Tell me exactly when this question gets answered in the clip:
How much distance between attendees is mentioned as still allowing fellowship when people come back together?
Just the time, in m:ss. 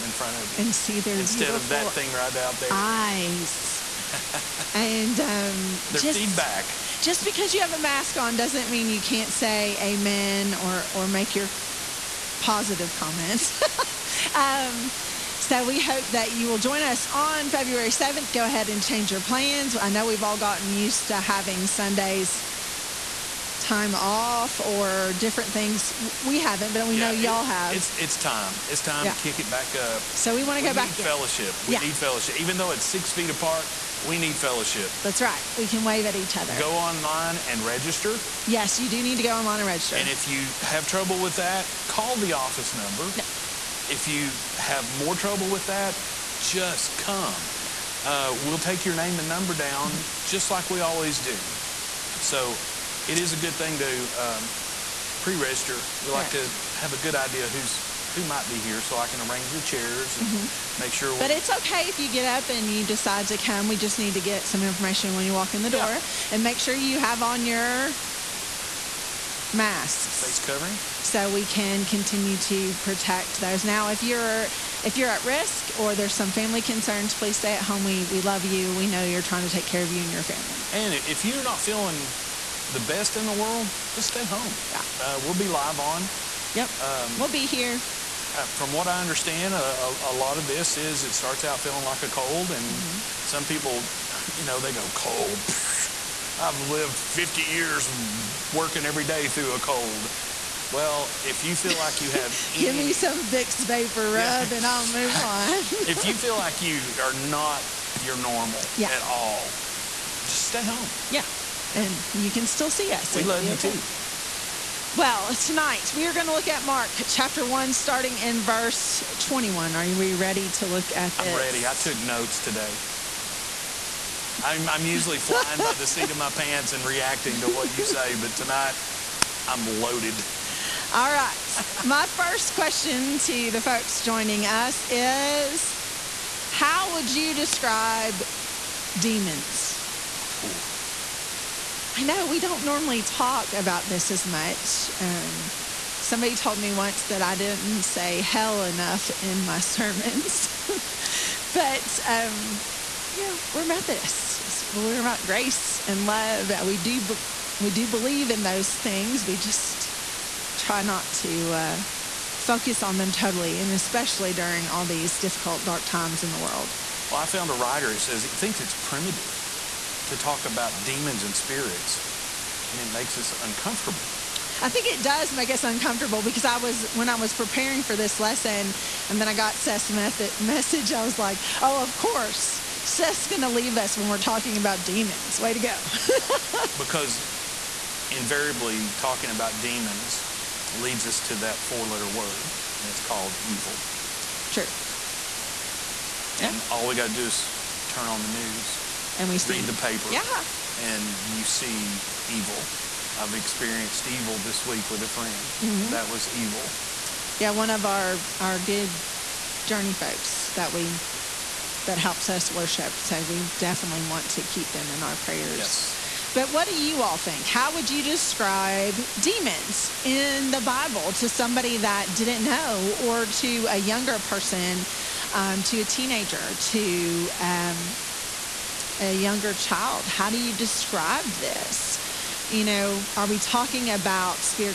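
0:32.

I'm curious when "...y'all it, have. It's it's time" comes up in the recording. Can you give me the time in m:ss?
0:27.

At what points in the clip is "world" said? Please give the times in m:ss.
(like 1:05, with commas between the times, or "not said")
1:23, 2:46.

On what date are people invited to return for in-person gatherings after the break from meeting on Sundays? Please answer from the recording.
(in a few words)
February 7.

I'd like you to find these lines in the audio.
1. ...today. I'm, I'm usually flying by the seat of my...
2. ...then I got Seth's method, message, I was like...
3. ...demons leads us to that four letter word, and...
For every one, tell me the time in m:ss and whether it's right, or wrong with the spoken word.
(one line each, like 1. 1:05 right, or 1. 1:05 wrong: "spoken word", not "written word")
1. 2:02 right
2. 2:59 right
3. 3:09 right.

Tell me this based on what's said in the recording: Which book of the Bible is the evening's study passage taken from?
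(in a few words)
Mark.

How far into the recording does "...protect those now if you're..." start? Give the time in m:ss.
1:12.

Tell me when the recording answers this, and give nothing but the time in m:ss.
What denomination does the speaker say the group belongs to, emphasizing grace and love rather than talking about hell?
2:33.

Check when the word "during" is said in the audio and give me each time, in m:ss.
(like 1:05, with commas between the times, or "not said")
2:44.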